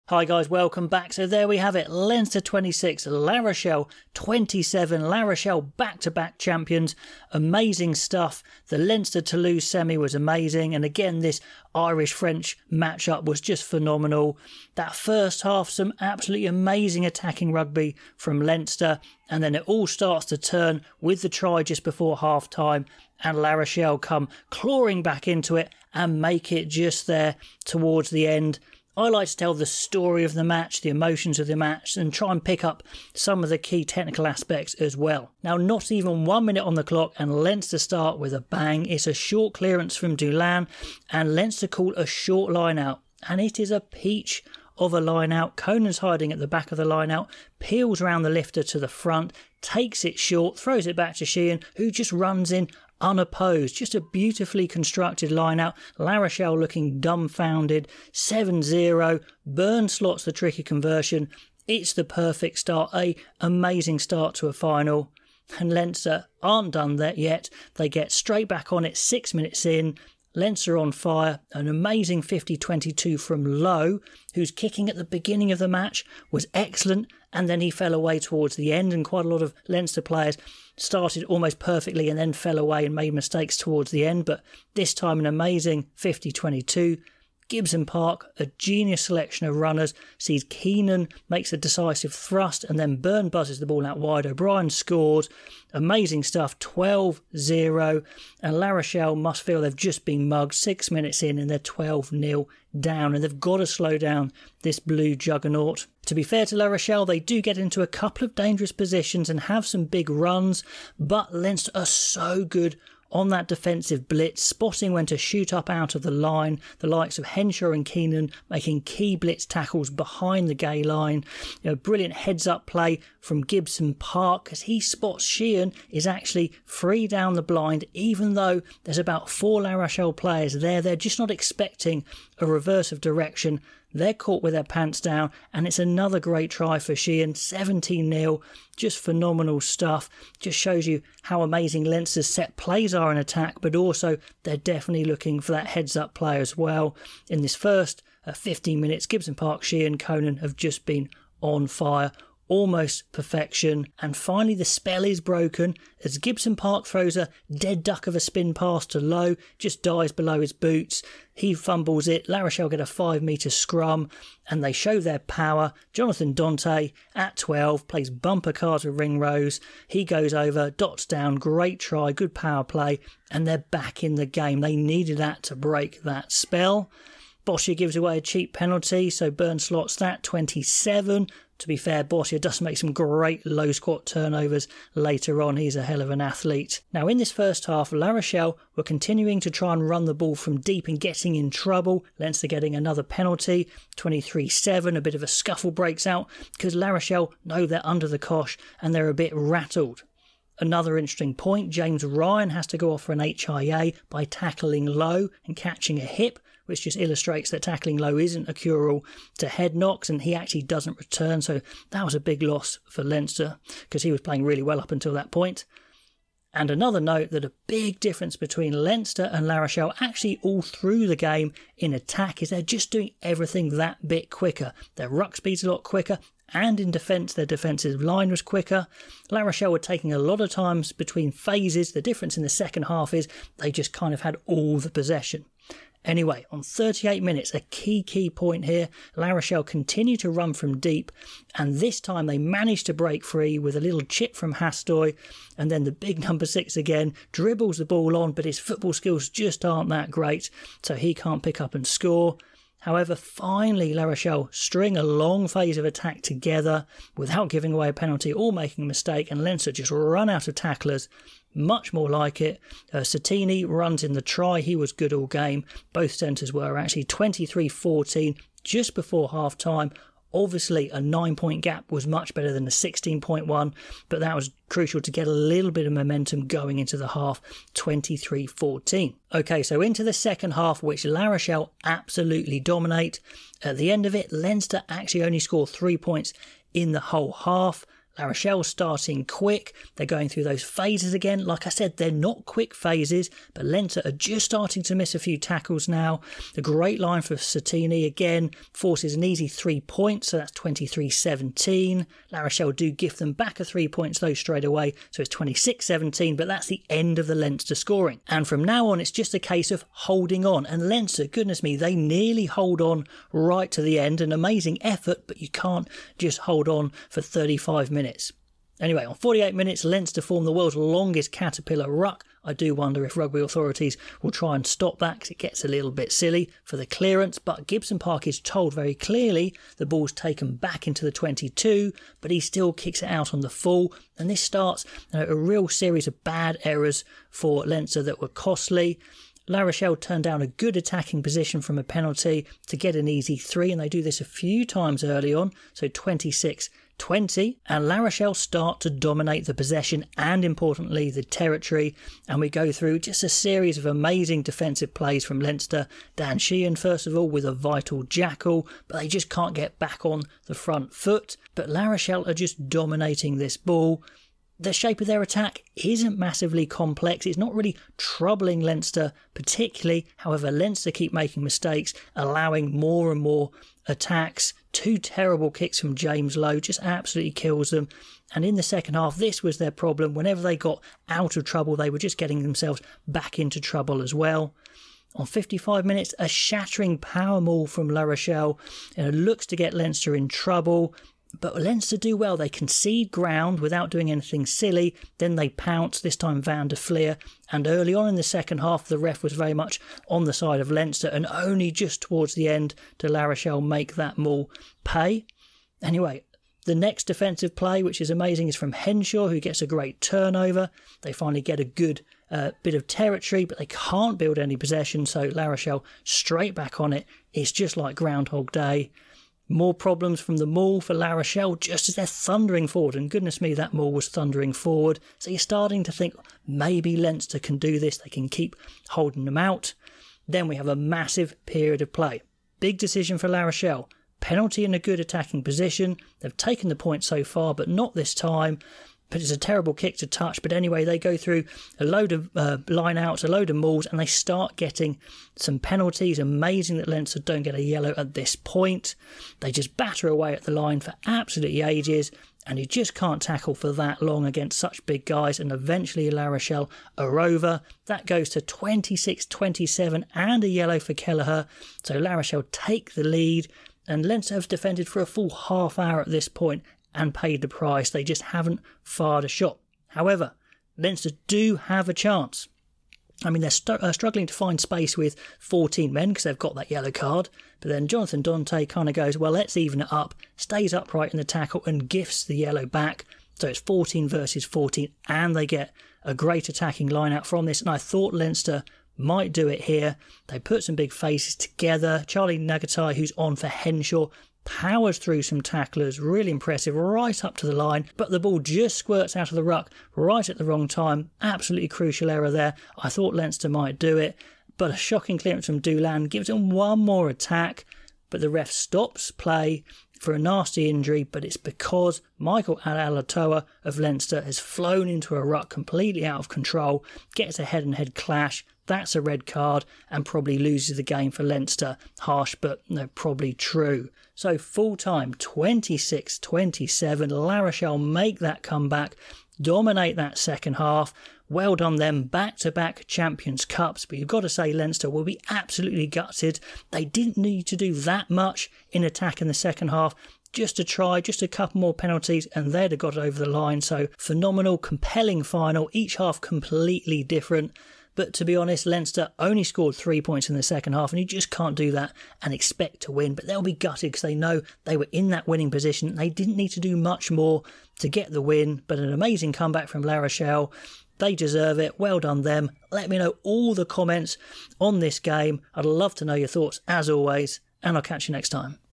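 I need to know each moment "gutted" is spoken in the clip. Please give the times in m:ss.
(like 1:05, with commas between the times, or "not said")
8:55, 9:13.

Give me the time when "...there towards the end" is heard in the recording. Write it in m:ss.
0:27.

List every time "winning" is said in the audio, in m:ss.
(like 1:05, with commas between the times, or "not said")
9:15.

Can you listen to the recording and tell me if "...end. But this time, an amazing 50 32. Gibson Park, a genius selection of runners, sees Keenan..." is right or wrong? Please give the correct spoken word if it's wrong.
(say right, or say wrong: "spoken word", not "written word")
wrong: "22", not "32".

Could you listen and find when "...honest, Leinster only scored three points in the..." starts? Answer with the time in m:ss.
9:08.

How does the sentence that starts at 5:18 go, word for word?
Anyway, on 48 minutes, Leinster to form the world's longest caterpillar ruck.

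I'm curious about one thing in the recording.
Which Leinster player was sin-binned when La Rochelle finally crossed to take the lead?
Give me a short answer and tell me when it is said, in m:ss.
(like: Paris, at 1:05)
Kelleher, at 7:40.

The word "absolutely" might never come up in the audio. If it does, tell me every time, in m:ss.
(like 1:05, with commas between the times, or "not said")
0:16, 4:41, 6:16, 7:31, 8:21, 8:55.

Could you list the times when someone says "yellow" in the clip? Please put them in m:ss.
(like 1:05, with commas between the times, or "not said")
7:27, 7:40, 7:56, 8:02.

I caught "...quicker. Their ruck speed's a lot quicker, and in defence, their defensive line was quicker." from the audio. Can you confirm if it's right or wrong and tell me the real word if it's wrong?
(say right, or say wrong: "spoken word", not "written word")
right.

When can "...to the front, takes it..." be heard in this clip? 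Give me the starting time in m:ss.
0:48.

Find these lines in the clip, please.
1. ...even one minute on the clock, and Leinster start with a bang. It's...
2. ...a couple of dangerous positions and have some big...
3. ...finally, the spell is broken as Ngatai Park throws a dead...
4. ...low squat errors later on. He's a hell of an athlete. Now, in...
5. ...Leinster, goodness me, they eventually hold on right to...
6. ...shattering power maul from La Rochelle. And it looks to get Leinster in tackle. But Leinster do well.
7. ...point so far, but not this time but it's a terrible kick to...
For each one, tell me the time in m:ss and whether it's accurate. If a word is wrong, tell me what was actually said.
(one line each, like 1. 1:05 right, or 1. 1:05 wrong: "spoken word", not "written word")
1. 0:35 right
2. 1:47 right
3. 2:34 wrong: "Gibson", not "Ngatai"
4. 3:03 wrong: "turnovers", not "errors"
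5. 5:10 wrong: "nearly", not "eventually"
6. 6:26 wrong: "trouble", not "tackle"
7. 7:16 right.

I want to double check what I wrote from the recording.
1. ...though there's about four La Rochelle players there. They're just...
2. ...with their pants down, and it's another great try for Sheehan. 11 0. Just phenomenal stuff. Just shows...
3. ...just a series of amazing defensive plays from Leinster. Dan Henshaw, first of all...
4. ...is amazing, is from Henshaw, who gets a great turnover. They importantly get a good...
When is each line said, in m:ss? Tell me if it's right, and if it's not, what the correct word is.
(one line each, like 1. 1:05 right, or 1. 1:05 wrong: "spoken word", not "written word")
1. 2:08 right
2. 2:14 wrong: "17", not "11"
3. 5:52 wrong: "Sheehan", not "Henshaw"
4. 6:48 wrong: "finally", not "importantly".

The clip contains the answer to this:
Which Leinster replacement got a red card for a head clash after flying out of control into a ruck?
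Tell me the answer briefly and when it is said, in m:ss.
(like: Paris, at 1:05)
Michael Ala'alatoa, at 8:32.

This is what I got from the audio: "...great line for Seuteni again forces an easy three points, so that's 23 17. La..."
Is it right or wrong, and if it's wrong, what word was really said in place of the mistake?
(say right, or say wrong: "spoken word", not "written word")
right.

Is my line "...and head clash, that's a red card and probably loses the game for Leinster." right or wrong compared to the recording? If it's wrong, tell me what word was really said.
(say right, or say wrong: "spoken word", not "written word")
right.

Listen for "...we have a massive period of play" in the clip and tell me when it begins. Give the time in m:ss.
7:10.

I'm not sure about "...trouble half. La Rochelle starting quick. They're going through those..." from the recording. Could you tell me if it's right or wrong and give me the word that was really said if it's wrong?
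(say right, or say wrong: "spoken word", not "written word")
wrong: "whole", not "trouble".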